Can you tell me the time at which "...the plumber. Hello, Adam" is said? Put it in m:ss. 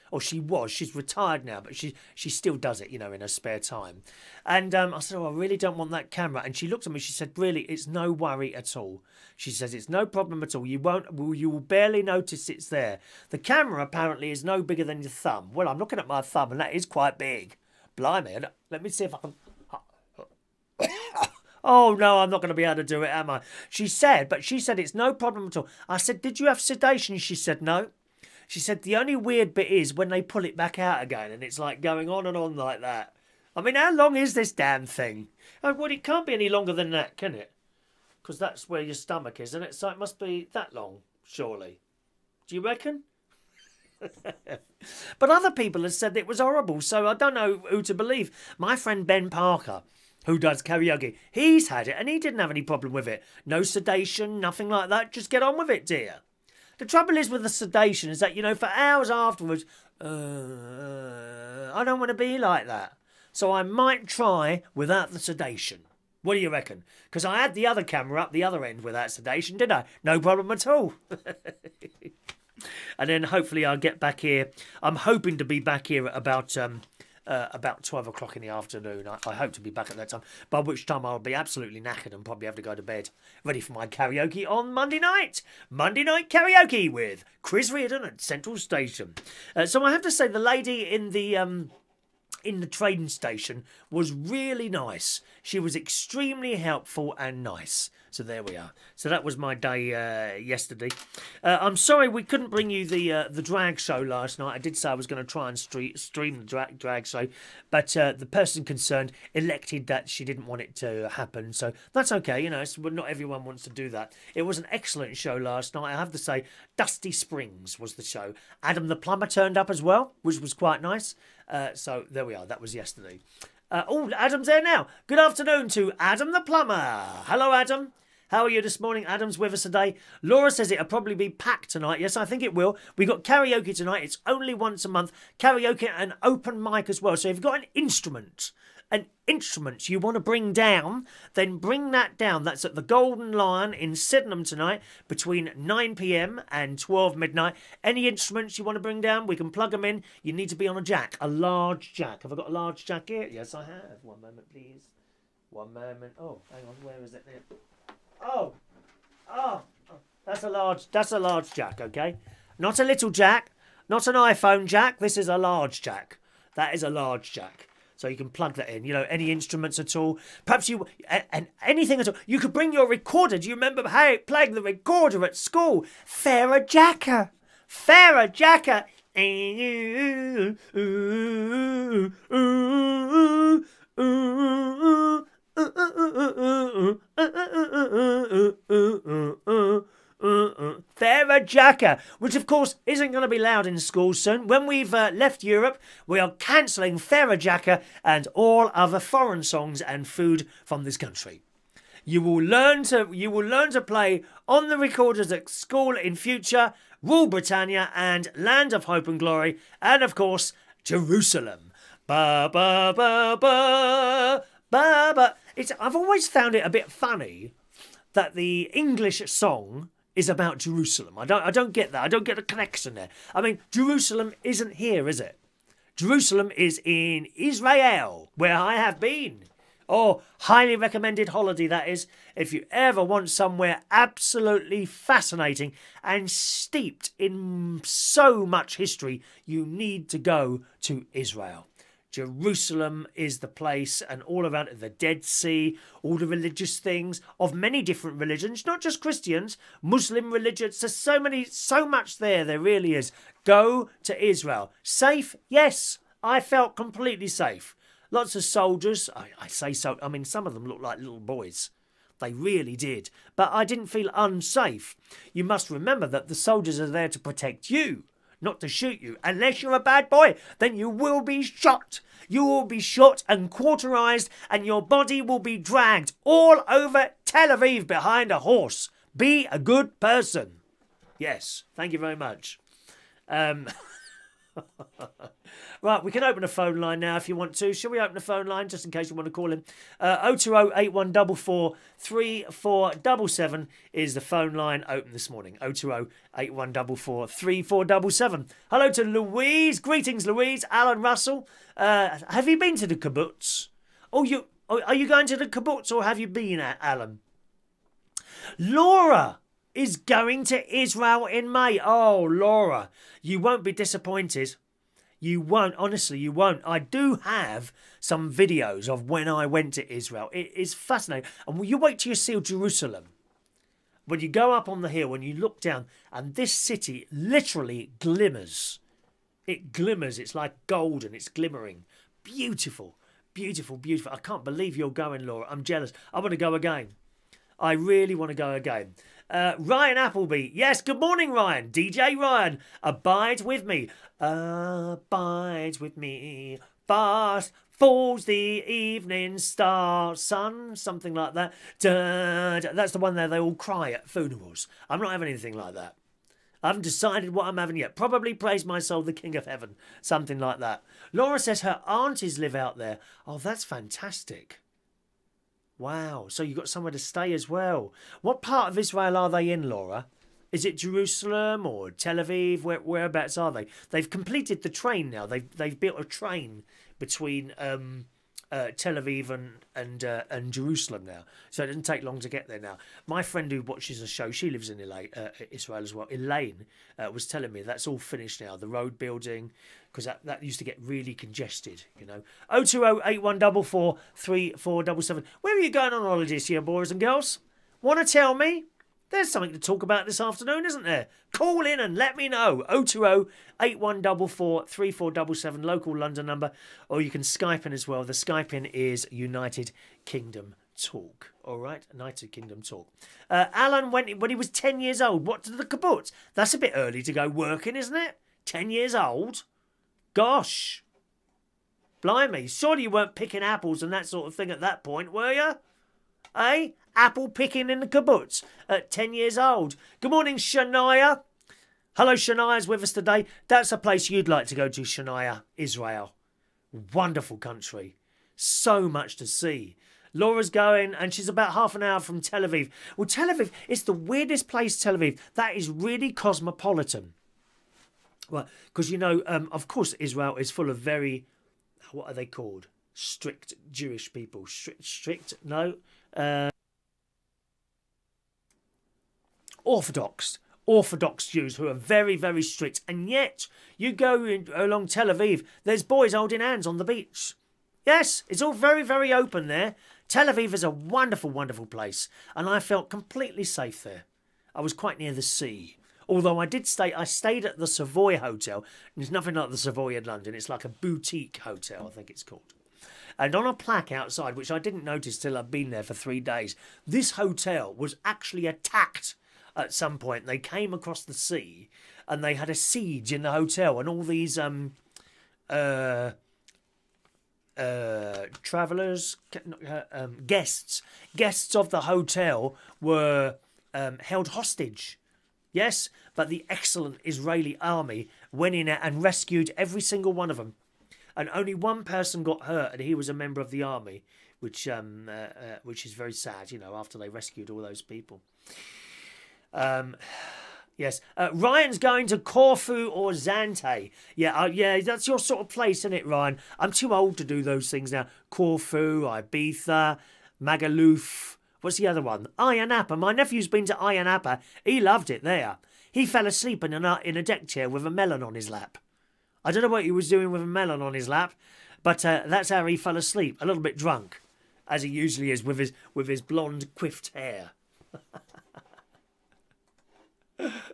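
2:06.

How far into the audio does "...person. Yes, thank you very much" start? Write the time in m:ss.
4:39.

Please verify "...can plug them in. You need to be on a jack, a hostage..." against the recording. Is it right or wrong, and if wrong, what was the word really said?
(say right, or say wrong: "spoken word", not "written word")
wrong: "large", not "hostage".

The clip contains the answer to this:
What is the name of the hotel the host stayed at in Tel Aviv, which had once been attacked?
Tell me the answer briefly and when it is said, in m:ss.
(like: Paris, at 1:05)
Savoy Hotel, at 7:57.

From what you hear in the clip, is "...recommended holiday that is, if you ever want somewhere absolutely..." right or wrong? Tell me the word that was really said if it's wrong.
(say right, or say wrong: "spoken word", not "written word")
right.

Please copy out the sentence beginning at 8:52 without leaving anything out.
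My nephew's been to Ayia Napa.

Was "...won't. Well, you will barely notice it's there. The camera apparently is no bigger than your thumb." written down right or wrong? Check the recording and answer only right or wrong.
right.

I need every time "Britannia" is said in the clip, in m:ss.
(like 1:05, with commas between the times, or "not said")
3:27.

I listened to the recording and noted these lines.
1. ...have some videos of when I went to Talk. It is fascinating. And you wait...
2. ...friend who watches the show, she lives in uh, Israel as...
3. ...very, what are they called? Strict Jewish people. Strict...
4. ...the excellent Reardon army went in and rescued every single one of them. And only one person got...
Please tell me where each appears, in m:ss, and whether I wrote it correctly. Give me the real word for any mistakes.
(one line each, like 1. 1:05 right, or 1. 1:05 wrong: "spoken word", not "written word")
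1. 5:17 wrong: "Israel", not "Talk"
2. 6:23 right
3. 7:30 right
4. 8:26 wrong: "Israeli", not "Reardon".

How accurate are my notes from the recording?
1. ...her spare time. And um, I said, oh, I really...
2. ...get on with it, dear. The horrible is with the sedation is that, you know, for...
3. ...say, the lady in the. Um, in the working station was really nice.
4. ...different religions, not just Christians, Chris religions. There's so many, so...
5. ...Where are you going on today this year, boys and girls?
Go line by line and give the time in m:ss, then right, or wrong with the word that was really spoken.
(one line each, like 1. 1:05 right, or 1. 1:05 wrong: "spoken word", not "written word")
1. 0:03 right
2. 0:55 wrong: "trouble", not "horrible"
3. 1:30 wrong: "trading", not "working"
4. 4:07 wrong: "Muslim", not "Chris"
5. 6:32 wrong: "holiday", not "today".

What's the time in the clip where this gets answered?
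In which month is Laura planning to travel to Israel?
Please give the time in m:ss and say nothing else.
5:11.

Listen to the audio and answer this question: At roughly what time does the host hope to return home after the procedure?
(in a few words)
12 o'clock.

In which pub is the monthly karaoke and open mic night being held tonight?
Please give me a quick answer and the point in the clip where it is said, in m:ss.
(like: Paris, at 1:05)
Golden Lion, at 2:22.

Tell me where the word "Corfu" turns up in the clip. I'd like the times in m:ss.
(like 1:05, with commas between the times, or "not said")
8:42, 8:48.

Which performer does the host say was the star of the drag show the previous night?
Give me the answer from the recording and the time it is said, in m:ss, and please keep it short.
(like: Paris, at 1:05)
Dusty Springs, at 1:56.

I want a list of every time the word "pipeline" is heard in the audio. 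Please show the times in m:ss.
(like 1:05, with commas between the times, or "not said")
not said.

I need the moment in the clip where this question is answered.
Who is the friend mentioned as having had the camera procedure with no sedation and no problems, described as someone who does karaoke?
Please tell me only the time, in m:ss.
0:49.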